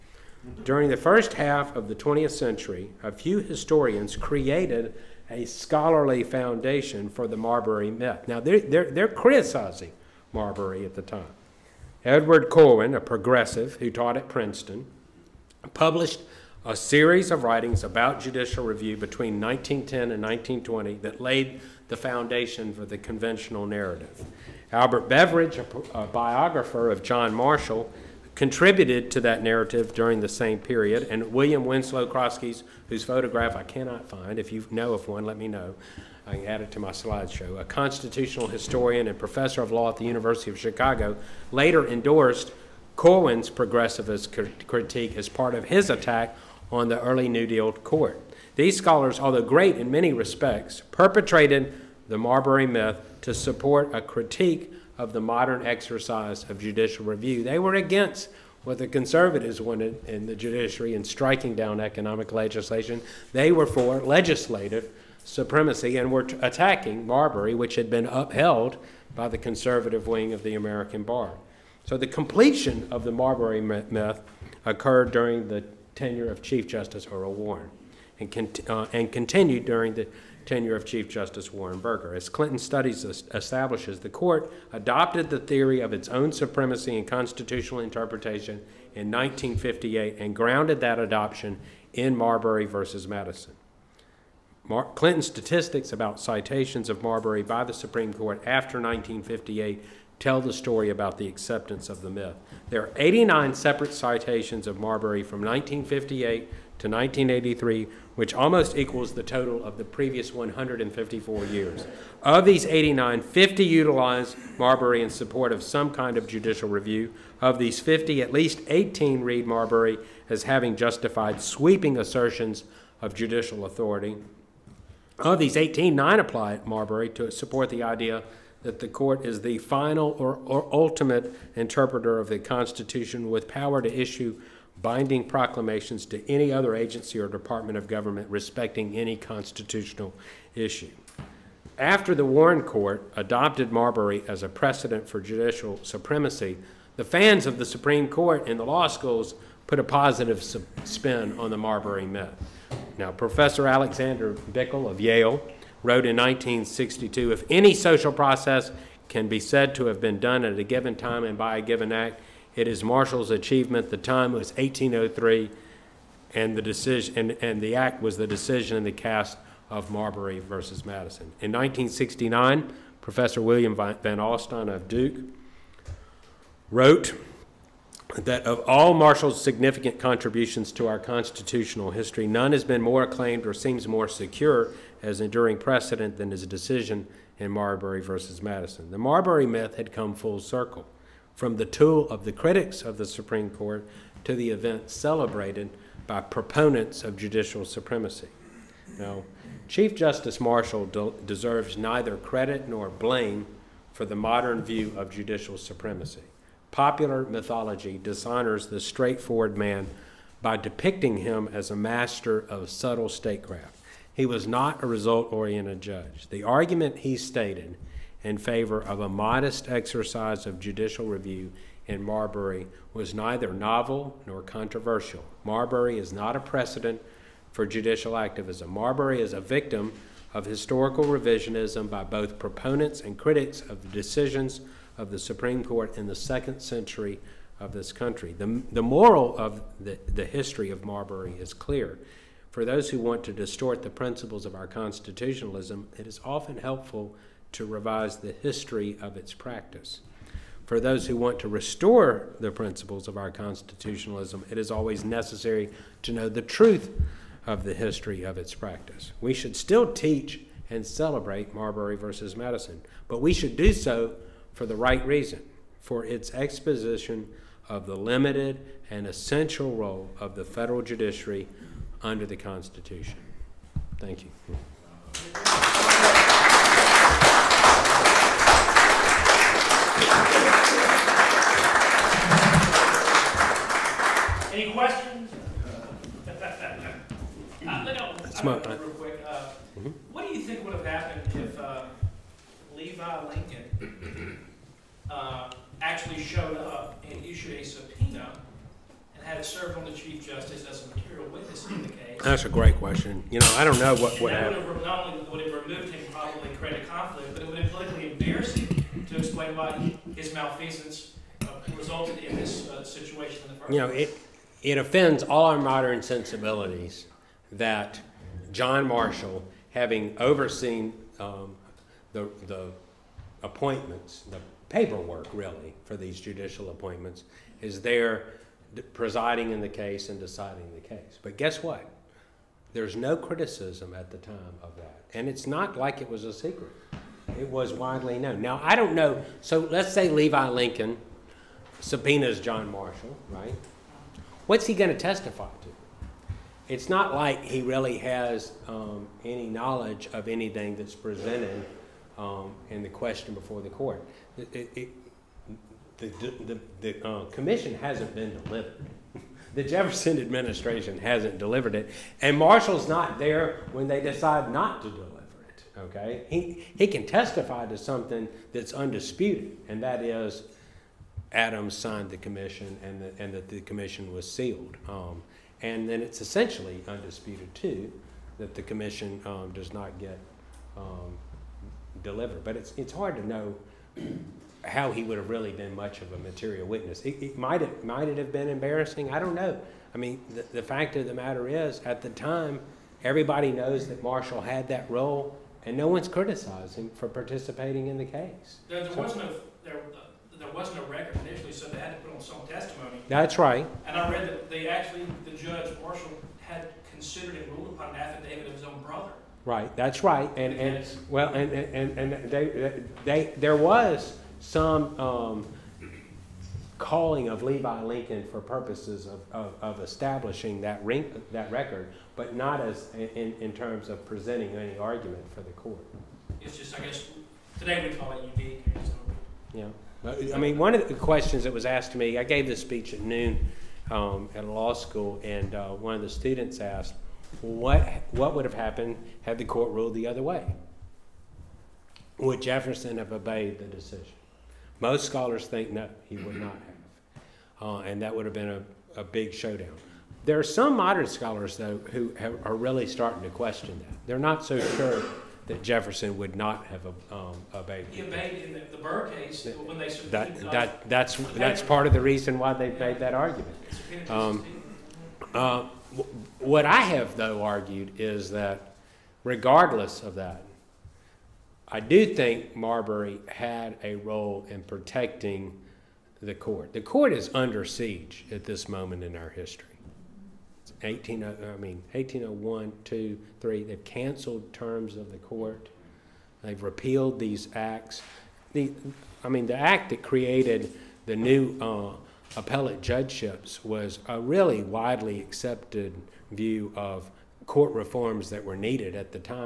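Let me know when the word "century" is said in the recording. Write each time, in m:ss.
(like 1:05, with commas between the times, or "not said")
0:02, 3:56.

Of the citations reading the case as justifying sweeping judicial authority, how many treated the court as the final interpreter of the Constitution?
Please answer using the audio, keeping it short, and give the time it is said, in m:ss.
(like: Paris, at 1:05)
nine, at 2:05.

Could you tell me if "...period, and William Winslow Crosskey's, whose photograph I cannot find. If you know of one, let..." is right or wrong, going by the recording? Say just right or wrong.
right.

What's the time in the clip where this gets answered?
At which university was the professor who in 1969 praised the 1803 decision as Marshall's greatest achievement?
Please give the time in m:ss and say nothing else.
2:54.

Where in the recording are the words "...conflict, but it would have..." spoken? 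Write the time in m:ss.
5:06.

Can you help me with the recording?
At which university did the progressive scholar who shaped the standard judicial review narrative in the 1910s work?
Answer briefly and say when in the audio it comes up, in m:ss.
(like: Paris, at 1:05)
Princeton, at 0:14.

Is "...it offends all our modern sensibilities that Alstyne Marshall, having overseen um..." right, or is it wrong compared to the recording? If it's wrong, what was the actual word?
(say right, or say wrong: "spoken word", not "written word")
wrong: "John", not "Alstyne".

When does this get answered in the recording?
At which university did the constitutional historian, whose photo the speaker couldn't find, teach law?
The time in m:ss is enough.
0:40.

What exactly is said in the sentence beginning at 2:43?
The time was 1803, and the decision and, and the act was the decision in the cast of Marbury versus Madison.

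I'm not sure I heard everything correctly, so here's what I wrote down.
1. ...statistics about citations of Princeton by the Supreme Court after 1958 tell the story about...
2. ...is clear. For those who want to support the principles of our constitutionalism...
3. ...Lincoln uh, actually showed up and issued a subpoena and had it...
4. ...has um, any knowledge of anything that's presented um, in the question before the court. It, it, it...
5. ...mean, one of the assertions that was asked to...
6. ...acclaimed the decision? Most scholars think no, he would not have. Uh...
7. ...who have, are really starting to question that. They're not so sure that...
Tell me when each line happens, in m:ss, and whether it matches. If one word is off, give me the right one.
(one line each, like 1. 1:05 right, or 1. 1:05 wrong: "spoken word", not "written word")
1. 1:35 wrong: "Marbury", not "Princeton"
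2. 4:01 wrong: "distort", not "support"
3. 4:53 right
4. 5:47 right
5. 7:10 wrong: "questions", not "assertions"
6. 7:23 wrong: "obeyed", not "acclaimed"
7. 7:31 right.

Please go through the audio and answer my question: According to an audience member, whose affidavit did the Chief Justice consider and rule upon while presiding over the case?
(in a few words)
his own brother.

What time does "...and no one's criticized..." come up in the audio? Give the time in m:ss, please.
6:35.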